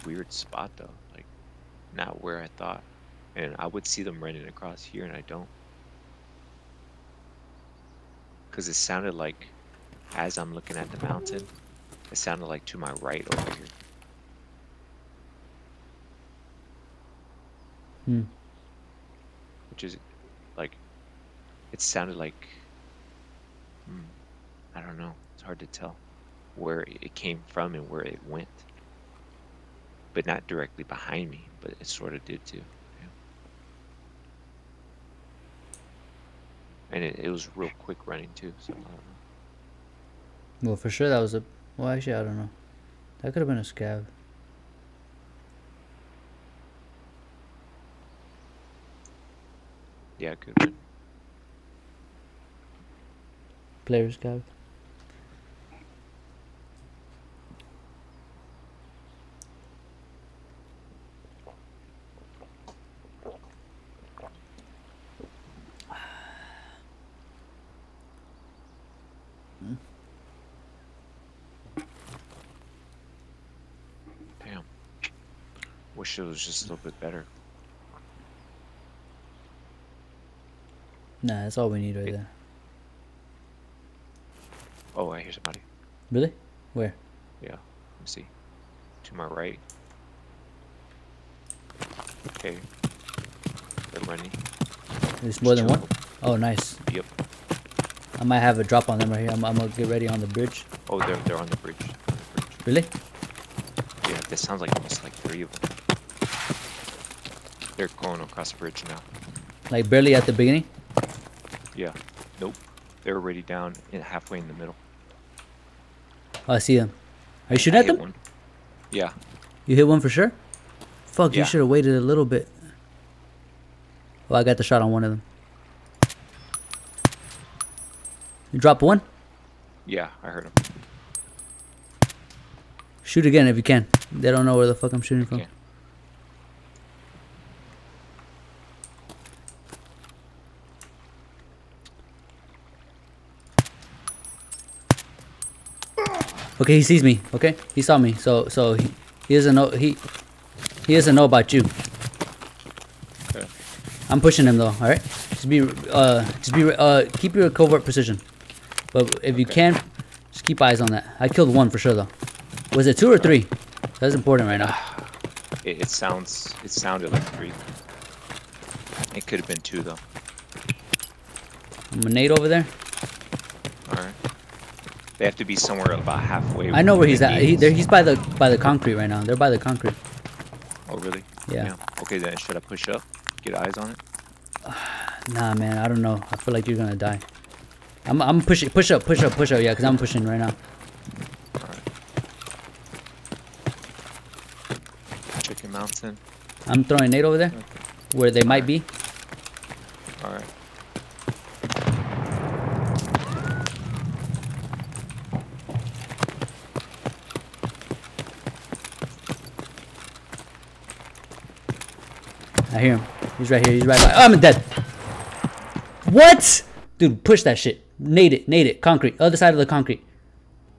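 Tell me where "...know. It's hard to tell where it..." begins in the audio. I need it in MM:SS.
00:24.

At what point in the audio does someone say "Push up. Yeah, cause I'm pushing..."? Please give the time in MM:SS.
03:09.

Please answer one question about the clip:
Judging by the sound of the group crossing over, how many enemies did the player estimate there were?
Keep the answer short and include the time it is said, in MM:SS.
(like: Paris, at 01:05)
3, at 01:44.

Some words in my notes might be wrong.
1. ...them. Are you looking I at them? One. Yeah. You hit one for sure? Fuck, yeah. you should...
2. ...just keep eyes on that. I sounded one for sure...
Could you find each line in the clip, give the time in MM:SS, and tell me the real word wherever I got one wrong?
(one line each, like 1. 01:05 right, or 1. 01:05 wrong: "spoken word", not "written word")
1. 01:56 wrong: "shooting", not "looking"
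2. 02:40 wrong: "killed", not "sounded".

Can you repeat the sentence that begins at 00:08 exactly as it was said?
Because it sounded like, as I'm looking at the mountain, it sounded like to my right over here.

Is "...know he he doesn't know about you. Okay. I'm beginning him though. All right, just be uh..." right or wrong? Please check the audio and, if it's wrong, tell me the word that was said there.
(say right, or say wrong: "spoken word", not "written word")
wrong: "pushing", not "beginning".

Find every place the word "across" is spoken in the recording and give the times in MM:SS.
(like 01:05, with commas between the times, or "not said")
00:04, 01:48.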